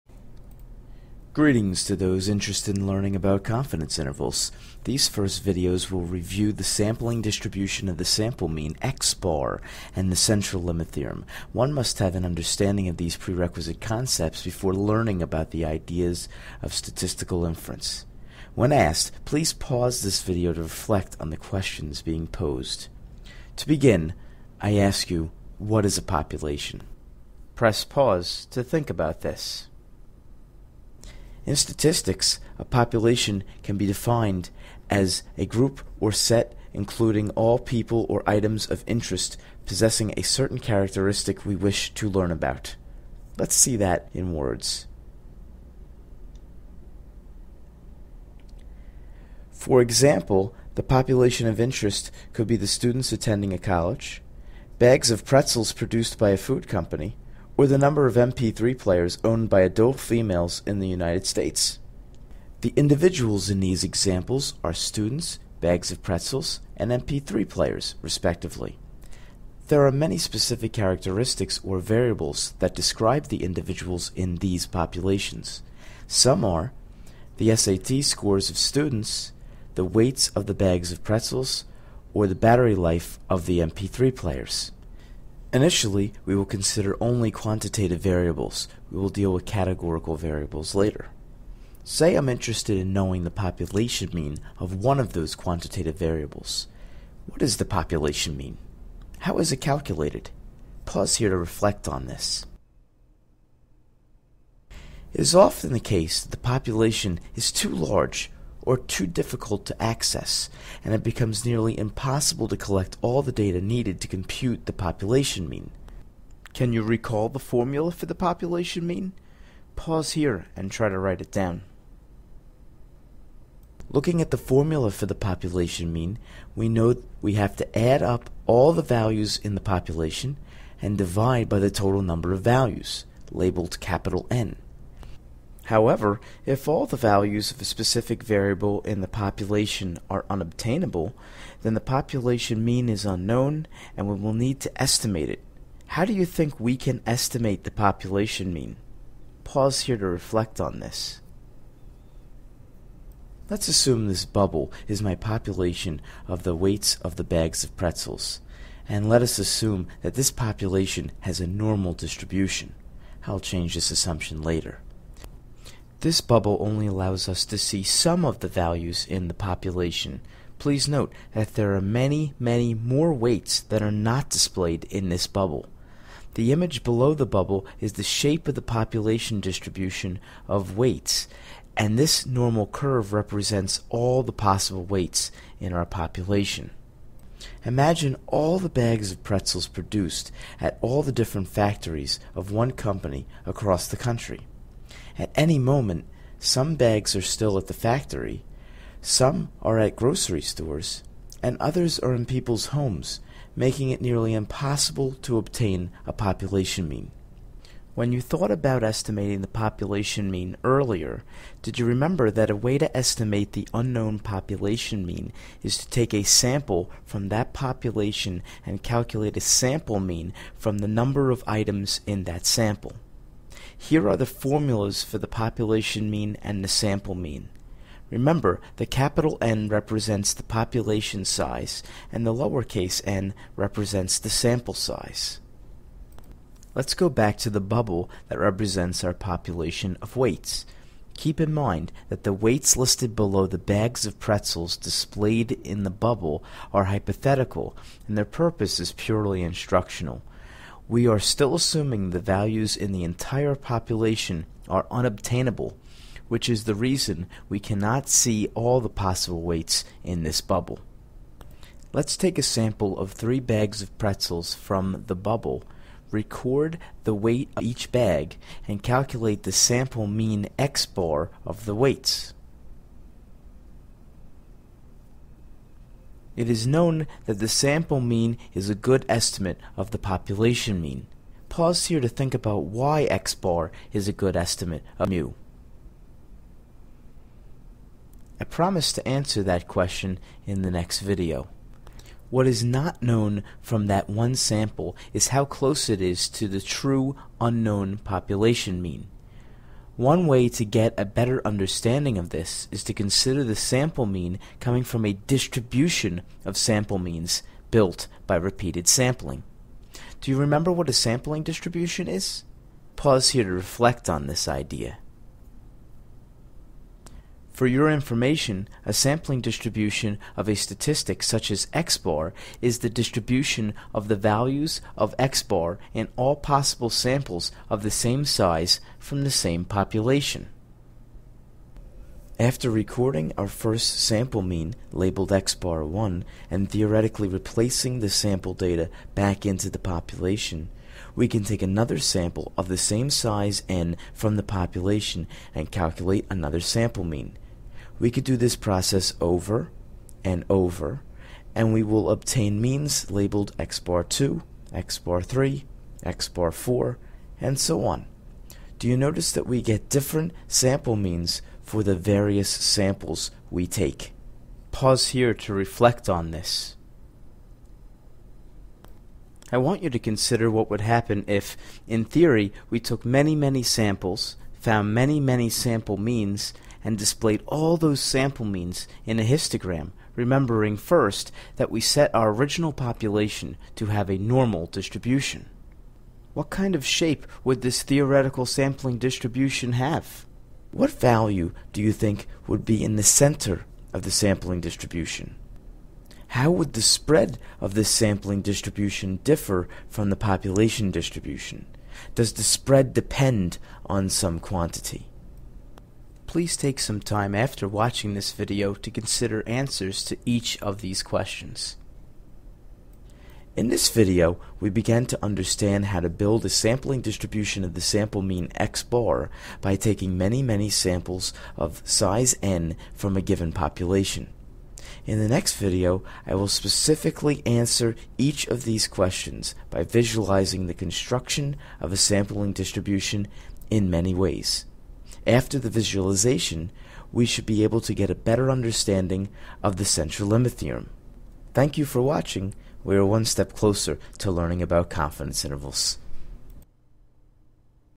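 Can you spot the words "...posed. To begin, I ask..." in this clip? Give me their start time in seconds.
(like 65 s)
22 s.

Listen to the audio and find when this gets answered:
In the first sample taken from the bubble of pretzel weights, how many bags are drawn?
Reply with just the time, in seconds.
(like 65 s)
263 s.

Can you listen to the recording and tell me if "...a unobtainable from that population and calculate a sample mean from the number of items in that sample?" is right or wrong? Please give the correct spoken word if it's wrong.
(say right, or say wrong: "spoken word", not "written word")
wrong: "sample", not "unobtainable".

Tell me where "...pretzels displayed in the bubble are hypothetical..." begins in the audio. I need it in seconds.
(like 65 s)
244 s.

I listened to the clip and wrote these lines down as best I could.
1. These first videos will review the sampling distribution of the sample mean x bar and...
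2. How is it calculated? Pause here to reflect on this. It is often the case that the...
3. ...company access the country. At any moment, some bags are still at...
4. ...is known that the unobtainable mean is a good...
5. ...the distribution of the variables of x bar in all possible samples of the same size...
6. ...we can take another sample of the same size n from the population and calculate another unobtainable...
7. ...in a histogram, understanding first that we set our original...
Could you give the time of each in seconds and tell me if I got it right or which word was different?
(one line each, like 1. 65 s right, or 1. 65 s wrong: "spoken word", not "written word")
1. 4 s right
2. 99 s right
3. 192 s wrong: "across", not "access"
4. 276 s wrong: "sample", not "unobtainable"
5. 322 s wrong: "values", not "variables"
6. 341 s wrong: "sample", not "unobtainable"
7. 379 s wrong: "remembering", not "understanding".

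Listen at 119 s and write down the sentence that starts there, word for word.
Pause here and try to write it down.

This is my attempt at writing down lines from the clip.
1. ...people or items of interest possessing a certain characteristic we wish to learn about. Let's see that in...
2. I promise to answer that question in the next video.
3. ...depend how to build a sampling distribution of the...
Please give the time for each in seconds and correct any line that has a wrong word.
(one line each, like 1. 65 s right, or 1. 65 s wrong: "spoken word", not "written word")
1. 37 s right
2. 288 s right
3. 415 s wrong: "understand", not "depend".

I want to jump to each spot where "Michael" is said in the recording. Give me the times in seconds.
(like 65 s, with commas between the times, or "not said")
not said.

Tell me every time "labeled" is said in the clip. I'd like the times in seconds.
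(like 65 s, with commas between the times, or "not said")
133 s, 334 s, 353 s.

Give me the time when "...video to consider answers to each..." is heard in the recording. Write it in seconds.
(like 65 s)
408 s.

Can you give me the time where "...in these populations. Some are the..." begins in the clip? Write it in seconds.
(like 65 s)
74 s.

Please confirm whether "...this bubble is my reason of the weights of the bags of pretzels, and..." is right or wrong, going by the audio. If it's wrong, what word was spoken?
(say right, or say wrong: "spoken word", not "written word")
wrong: "population", not "reason".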